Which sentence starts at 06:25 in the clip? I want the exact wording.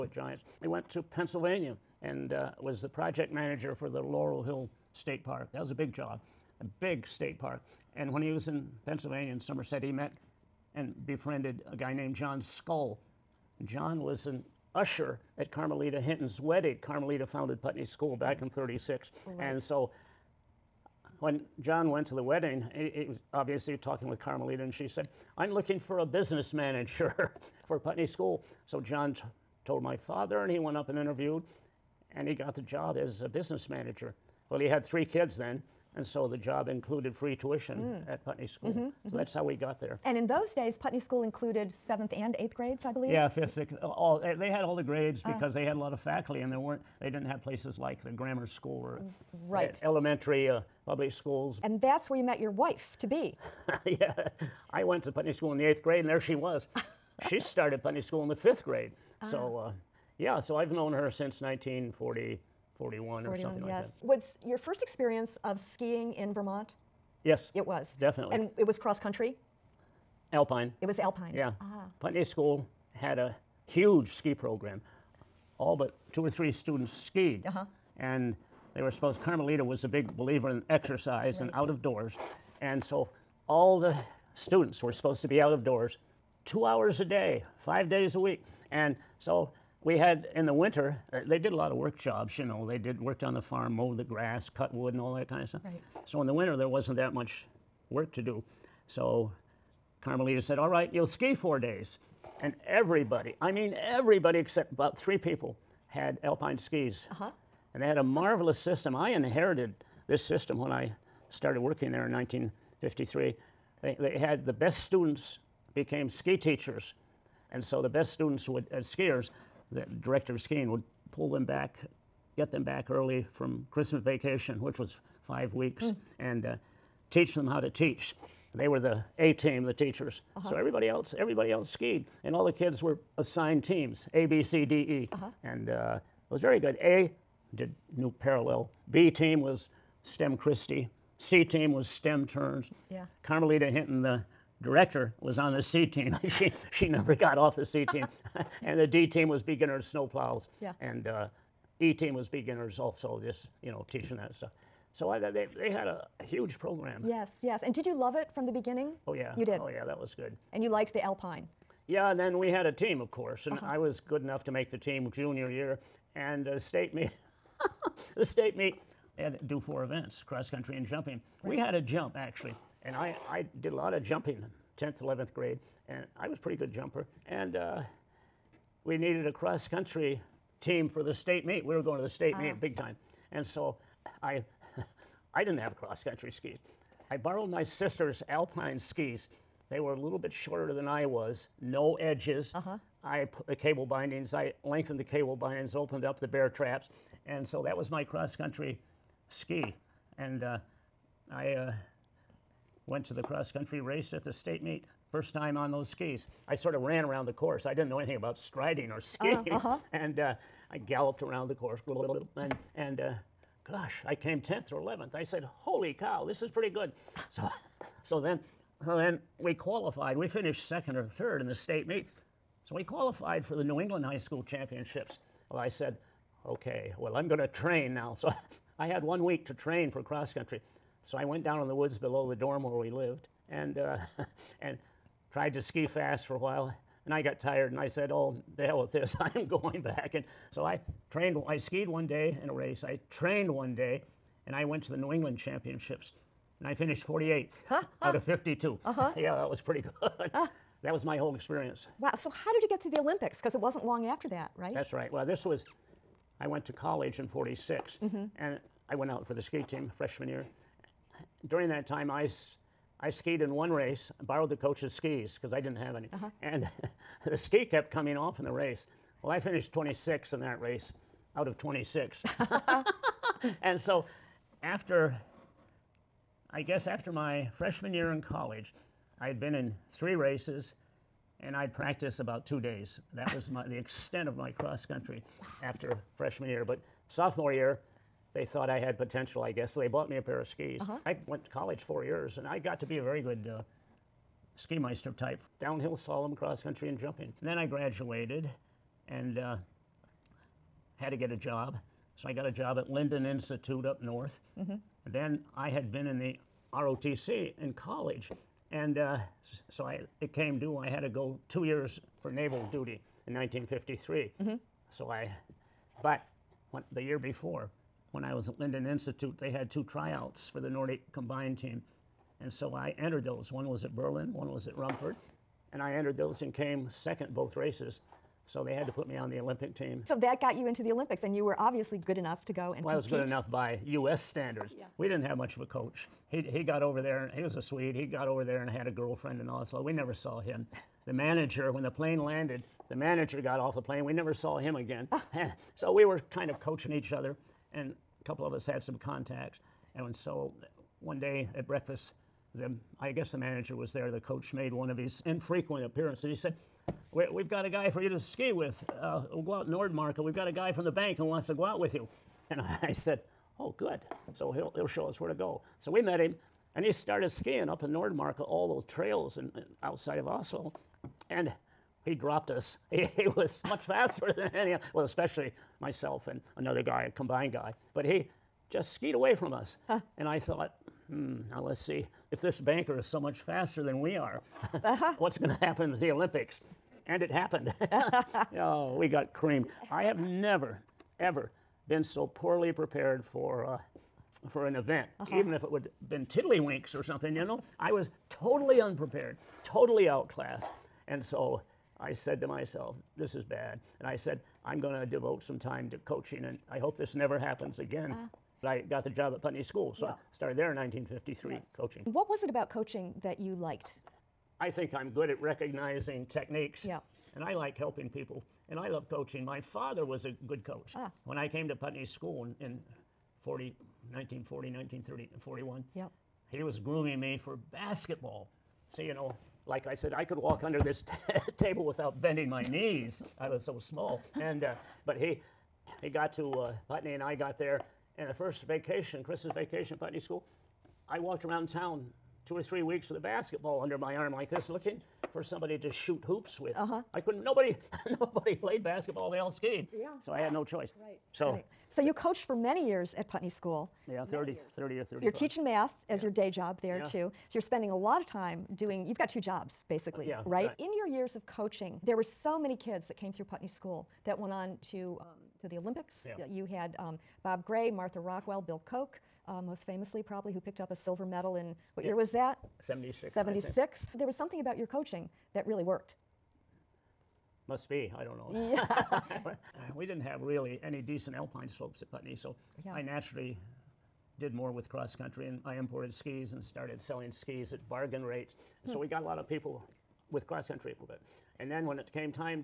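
what's going to happen at the Olympics?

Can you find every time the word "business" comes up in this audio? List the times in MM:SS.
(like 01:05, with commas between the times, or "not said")
00:26, 00:33.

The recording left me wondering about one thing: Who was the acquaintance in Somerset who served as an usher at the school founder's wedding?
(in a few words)
John Skull.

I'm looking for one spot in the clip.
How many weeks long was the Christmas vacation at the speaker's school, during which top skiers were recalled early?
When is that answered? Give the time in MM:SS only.
02:05.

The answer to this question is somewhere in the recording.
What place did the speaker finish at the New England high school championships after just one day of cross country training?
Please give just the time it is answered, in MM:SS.
04:07.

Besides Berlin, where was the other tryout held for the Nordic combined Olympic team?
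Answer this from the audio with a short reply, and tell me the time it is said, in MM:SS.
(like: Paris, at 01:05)
Rumford, at 05:24.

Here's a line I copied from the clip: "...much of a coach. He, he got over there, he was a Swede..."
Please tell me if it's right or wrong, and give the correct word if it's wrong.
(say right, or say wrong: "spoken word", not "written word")
right.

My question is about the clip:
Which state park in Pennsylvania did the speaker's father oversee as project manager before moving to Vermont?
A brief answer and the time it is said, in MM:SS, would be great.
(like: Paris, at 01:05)
Laurel Hill State Park, at 00:03.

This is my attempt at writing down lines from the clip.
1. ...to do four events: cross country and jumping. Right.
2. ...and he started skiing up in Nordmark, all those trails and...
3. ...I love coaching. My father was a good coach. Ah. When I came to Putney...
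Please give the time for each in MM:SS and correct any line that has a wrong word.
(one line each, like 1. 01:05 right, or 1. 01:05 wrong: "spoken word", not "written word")
1. 02:49 right
2. 06:06 right
3. 06:58 right.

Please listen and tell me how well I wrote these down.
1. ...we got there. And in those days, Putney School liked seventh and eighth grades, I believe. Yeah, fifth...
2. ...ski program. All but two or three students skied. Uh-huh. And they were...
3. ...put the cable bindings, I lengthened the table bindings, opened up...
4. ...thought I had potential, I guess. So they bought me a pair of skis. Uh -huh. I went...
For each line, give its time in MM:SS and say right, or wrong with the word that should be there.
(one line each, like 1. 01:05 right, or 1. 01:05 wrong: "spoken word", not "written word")
1. 00:39 wrong: "included", not "liked"
2. 01:14 right
3. 03:13 wrong: "cable", not "table"
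4. 04:48 right.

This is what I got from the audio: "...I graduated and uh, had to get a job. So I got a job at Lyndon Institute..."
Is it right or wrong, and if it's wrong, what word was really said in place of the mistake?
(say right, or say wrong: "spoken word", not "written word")
right.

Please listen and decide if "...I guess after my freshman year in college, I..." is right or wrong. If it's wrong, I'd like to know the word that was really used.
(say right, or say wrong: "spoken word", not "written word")
right.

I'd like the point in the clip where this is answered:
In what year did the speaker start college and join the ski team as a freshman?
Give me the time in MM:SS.
04:17.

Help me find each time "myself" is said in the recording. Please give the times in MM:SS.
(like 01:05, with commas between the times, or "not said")
06:15, 06:42.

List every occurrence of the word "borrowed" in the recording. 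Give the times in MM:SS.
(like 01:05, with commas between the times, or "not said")
03:07, 04:24.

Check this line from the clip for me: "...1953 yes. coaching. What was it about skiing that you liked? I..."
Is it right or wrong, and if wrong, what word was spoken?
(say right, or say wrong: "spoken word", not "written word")
wrong: "coaching", not "skiing".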